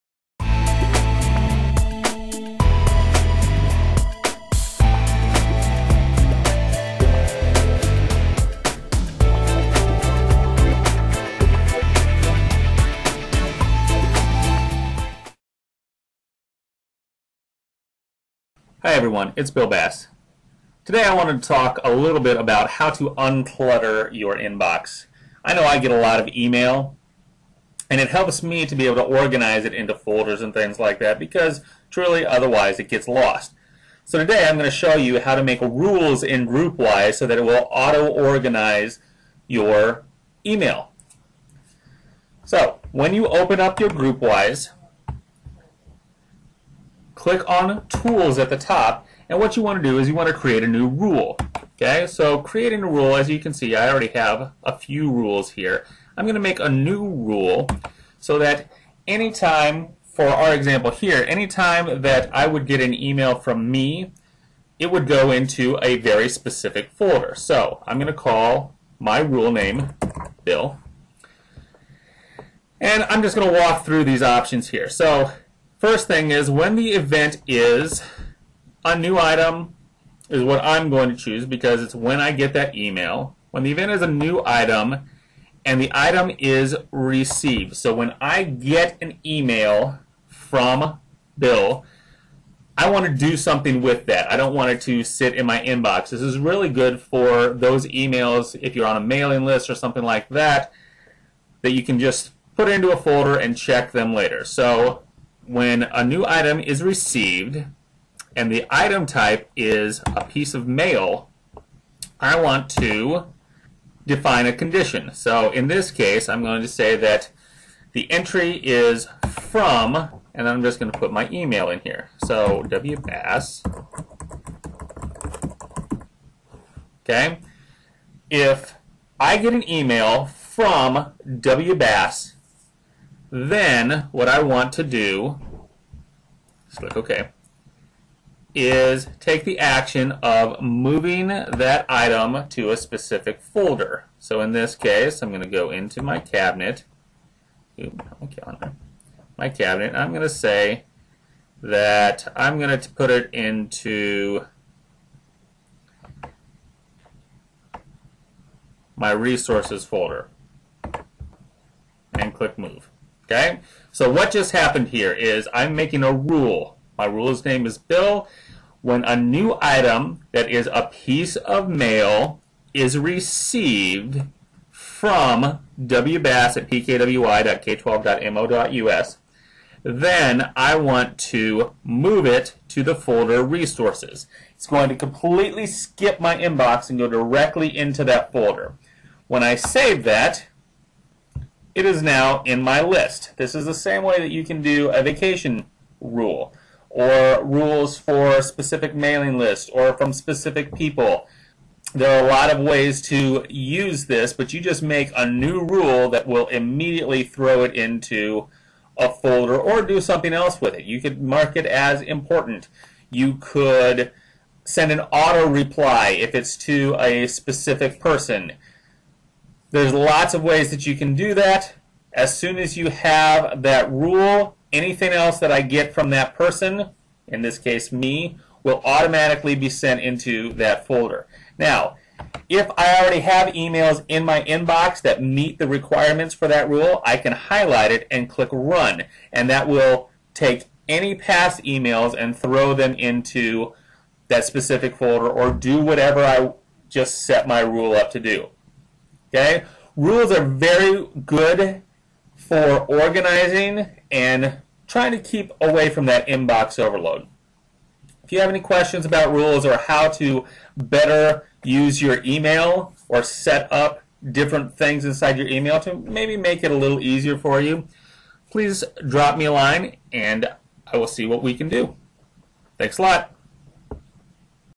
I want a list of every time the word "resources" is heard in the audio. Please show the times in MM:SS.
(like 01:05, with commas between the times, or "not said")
02:39, 03:03.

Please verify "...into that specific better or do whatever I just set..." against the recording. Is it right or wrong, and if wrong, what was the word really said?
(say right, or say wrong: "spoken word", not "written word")
wrong: "folder", not "better".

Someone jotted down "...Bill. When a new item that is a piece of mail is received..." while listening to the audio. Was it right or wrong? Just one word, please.
right.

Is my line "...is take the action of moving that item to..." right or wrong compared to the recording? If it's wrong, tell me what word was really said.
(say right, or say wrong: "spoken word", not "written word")
right.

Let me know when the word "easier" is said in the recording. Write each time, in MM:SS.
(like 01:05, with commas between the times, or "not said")
04:26.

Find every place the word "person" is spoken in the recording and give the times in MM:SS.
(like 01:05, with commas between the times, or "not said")
03:37, 03:46.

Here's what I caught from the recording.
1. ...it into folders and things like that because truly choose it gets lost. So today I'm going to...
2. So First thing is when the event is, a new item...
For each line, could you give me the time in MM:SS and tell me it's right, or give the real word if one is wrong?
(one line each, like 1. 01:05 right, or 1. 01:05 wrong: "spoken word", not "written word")
1. 00:29 wrong: "otherwise", not "choose"
2. 01:14 right.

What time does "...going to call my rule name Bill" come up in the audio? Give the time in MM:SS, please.
01:07.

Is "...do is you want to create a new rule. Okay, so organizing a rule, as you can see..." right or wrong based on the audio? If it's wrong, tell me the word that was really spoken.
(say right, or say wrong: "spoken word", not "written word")
wrong: "creating", not "organizing".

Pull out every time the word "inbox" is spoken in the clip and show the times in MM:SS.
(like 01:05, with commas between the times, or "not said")
00:24, 01:35, 03:06, 03:54, 04:16.